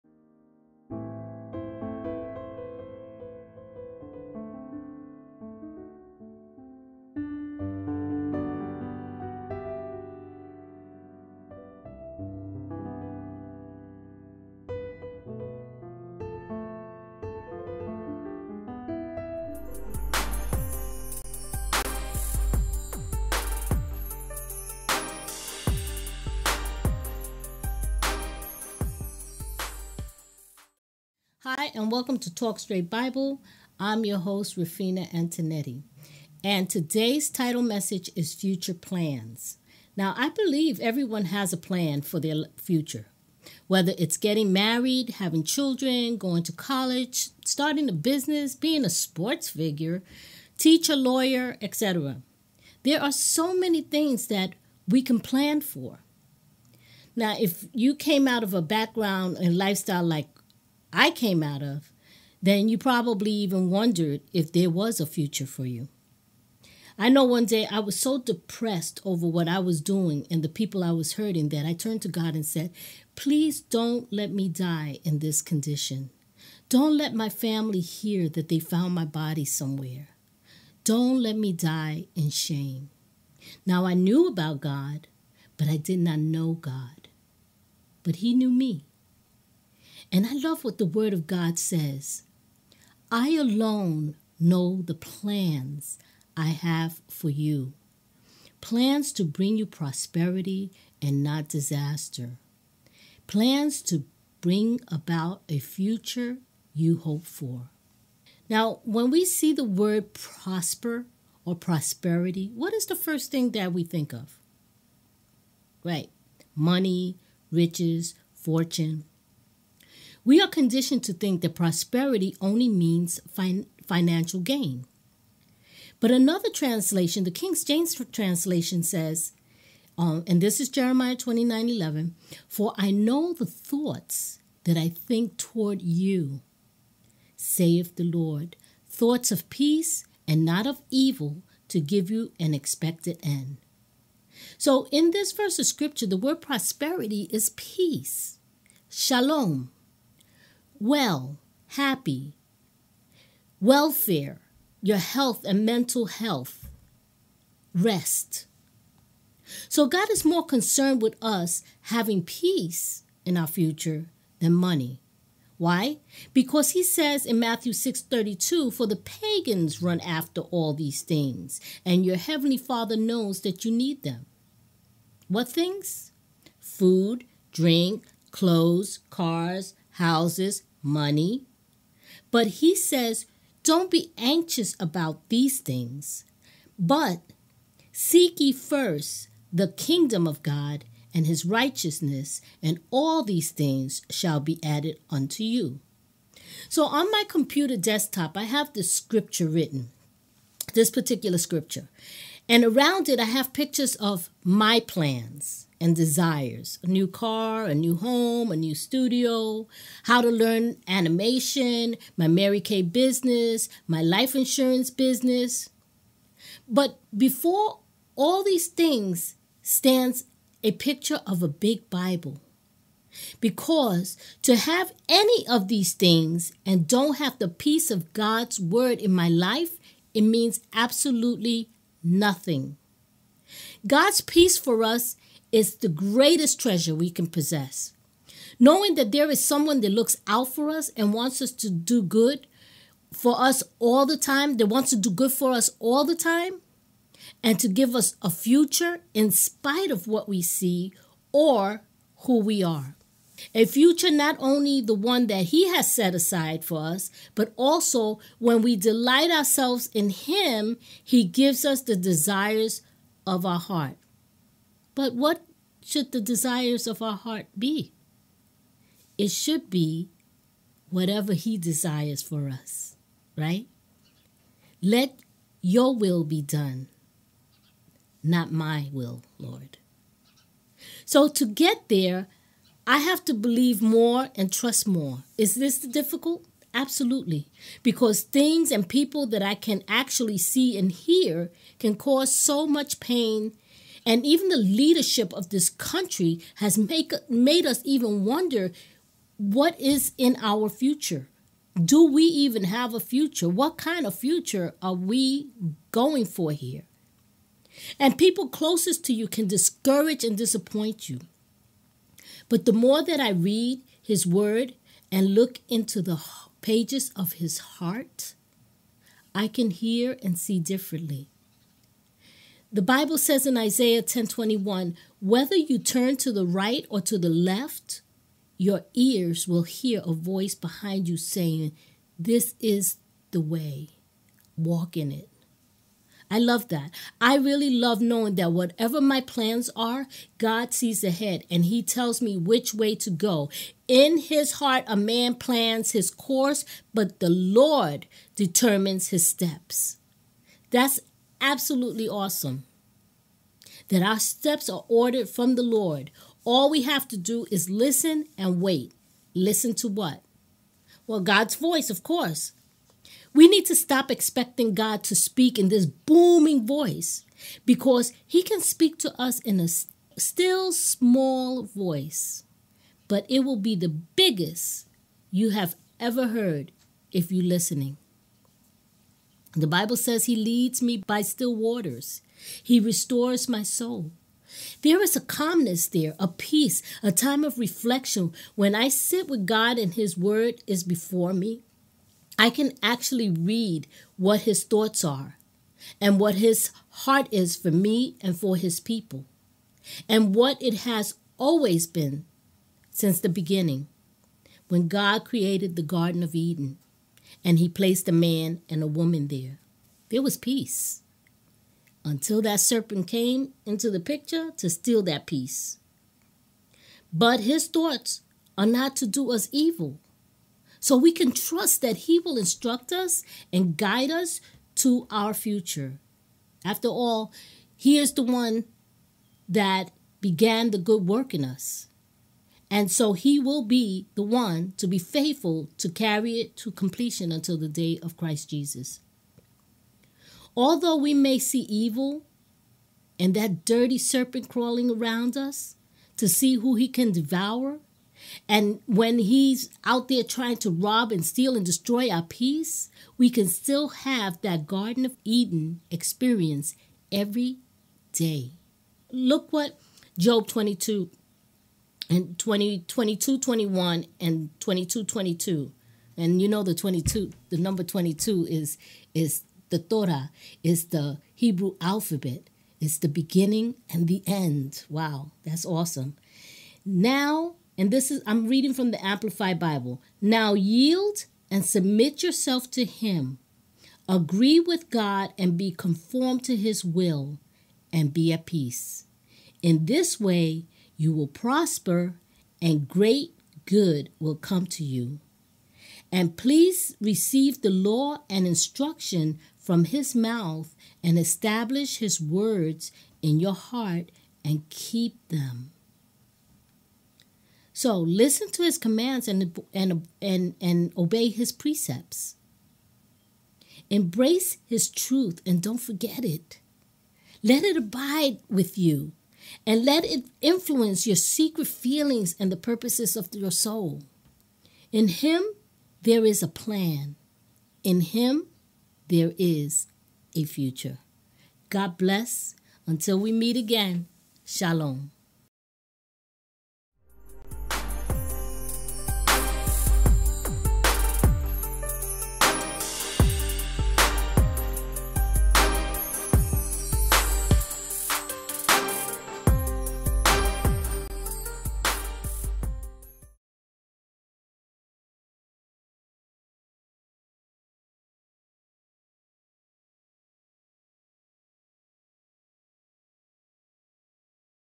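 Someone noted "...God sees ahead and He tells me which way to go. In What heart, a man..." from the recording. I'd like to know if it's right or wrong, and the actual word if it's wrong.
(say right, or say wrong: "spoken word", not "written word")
wrong: "His", not "What".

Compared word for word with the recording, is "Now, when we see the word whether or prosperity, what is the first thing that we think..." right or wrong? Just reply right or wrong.
wrong.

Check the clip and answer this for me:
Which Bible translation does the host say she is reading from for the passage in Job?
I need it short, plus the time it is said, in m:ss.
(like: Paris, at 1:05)
Amplified Bible, at 7:59.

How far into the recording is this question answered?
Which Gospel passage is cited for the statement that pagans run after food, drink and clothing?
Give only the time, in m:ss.
2:47.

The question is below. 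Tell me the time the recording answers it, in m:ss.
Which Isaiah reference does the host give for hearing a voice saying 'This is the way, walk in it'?
5:23.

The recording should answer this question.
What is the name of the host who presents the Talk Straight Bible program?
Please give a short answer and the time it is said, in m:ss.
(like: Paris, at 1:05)
Rafina Antonetti, at 0:34.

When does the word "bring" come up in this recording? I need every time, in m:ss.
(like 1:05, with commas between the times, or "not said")
1:39, 1:44.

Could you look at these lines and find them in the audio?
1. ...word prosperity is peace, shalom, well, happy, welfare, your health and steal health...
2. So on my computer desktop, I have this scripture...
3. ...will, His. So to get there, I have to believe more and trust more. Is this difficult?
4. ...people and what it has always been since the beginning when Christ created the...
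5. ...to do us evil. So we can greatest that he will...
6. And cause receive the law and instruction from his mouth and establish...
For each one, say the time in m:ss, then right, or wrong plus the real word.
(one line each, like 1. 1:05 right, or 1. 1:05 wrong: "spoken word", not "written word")
1. 2:26 wrong: "mental", not "steal"
2. 3:16 right
3. 4:38 wrong: "Lord", not "His"
4. 6:38 wrong: "God", not "Christ"
5. 6:58 wrong: "trust", not "greatest"
6. 8:16 wrong: "please", not "cause".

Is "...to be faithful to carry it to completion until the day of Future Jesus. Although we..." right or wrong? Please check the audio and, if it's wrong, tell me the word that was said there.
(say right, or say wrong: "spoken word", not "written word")
wrong: "Christ", not "Future".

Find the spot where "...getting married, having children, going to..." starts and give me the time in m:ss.
0:44.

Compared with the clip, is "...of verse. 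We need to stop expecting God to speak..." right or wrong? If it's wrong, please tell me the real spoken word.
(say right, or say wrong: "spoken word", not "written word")
wrong: "course", not "verse".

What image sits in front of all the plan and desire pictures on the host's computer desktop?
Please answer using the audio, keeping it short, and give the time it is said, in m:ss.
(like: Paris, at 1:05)
a big Bible, at 3:41.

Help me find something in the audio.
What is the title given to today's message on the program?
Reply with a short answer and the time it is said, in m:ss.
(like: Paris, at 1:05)
Future Plans, at 0:38.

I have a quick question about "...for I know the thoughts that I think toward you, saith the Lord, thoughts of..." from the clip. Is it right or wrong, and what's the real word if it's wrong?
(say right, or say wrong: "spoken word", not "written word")
right.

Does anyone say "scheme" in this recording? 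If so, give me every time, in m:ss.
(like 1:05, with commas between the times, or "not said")
not said.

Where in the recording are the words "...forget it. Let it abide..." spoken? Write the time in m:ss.
8:35.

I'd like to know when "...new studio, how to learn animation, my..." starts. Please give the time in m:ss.
3:28.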